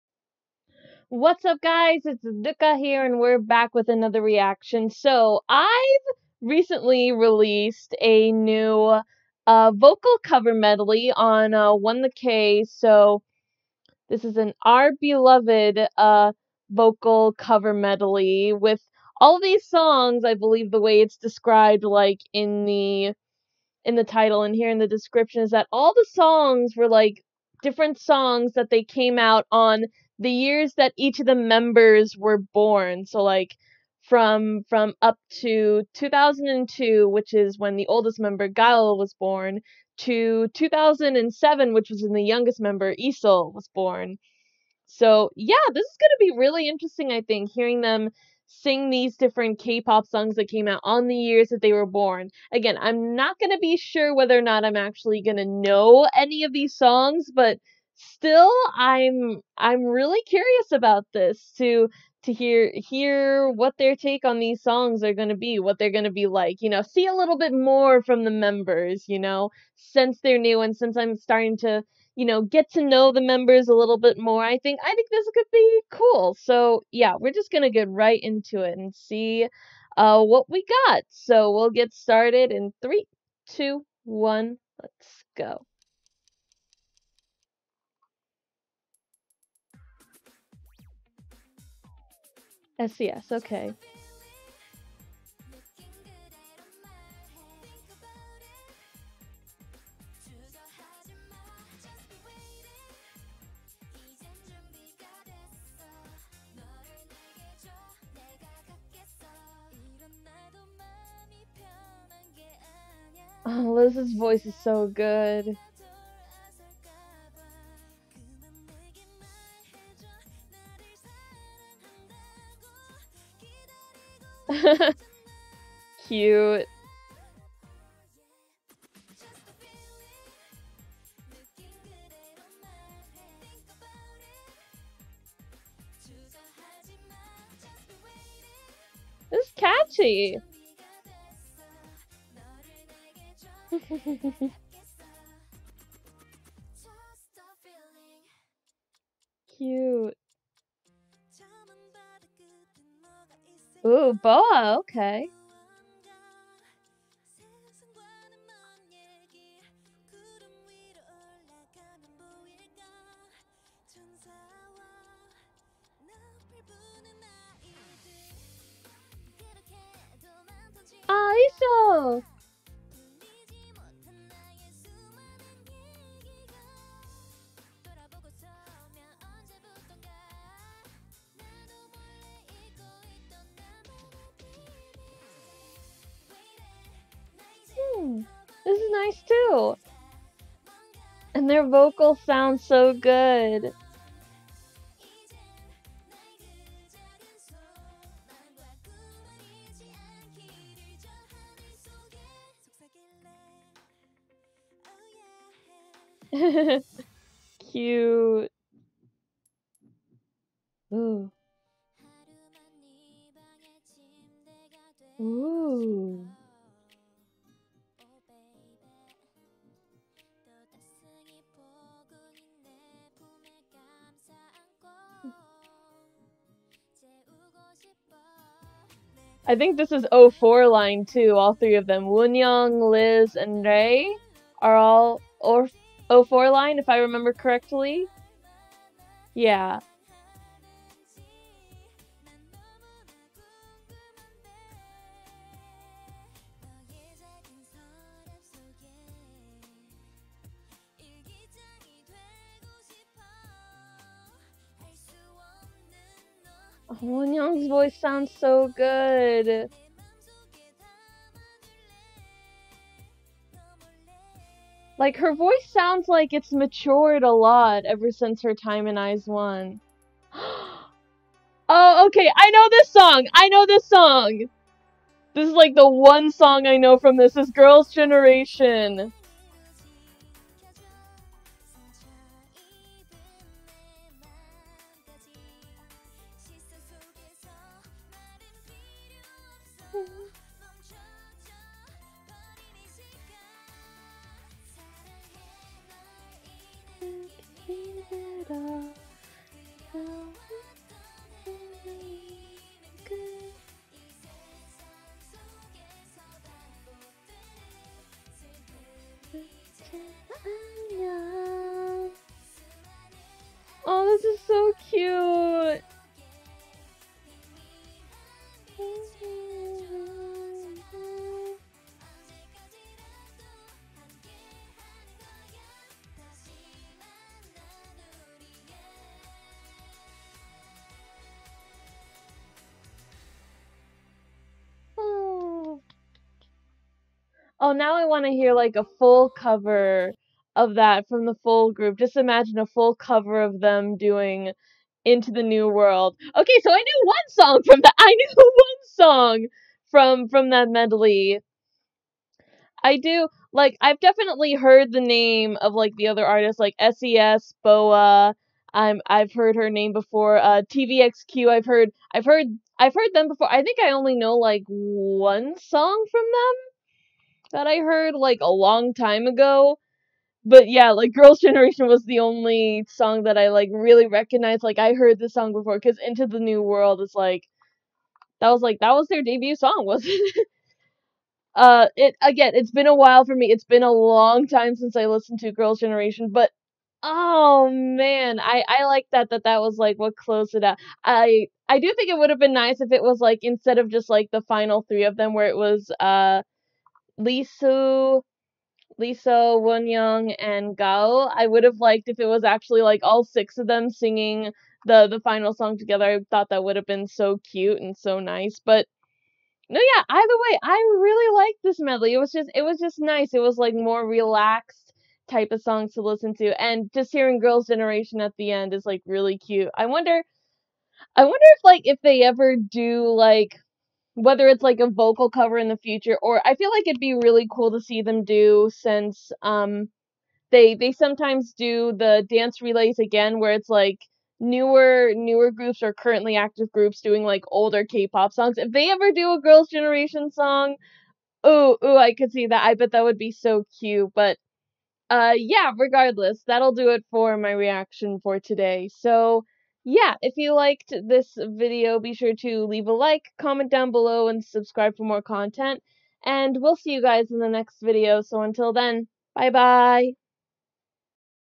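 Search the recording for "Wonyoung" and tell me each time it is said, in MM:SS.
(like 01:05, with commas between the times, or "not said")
03:52, 04:16, 06:39.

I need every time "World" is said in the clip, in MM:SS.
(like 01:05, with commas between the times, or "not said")
05:45, 06:16.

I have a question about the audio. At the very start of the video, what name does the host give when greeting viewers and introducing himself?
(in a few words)
Ruka.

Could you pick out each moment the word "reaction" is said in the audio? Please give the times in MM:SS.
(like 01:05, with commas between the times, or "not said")
00:04, 07:27.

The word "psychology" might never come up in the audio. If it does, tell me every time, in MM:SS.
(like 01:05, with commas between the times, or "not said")
not said.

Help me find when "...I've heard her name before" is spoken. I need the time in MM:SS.
05:59.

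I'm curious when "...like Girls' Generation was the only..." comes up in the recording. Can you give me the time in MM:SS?
06:10.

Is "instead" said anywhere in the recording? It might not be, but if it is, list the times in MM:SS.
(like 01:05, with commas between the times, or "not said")
06:33.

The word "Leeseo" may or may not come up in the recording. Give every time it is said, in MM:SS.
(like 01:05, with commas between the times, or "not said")
00:42, 06:37.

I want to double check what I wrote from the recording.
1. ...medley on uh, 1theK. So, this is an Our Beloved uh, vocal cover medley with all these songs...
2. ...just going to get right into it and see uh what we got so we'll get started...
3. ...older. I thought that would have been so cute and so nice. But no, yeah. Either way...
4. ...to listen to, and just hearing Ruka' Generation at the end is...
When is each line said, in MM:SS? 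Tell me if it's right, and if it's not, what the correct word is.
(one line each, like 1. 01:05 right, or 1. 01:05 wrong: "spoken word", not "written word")
1. 00:10 right
2. 01:17 right
3. 06:45 wrong: "together", not "older"
4. 06:55 wrong: "Girls", not "Ruka".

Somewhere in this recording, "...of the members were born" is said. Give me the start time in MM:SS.
00:31.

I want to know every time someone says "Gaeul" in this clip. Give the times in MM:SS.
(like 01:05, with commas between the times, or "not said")
00:38, 06:40.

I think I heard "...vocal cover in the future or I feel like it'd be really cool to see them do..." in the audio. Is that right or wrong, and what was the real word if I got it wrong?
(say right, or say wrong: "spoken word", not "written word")
right.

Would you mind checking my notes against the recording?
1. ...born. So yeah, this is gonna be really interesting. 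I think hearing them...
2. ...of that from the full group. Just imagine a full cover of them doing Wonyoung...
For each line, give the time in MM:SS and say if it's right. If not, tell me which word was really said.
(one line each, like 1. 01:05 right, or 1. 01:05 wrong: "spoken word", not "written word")
1. 00:43 right
2. 05:40 wrong: "Into", not "Wonyoung".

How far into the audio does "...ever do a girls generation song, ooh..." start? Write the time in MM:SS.
07:18.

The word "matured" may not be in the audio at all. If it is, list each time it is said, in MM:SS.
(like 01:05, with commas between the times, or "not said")
04:26.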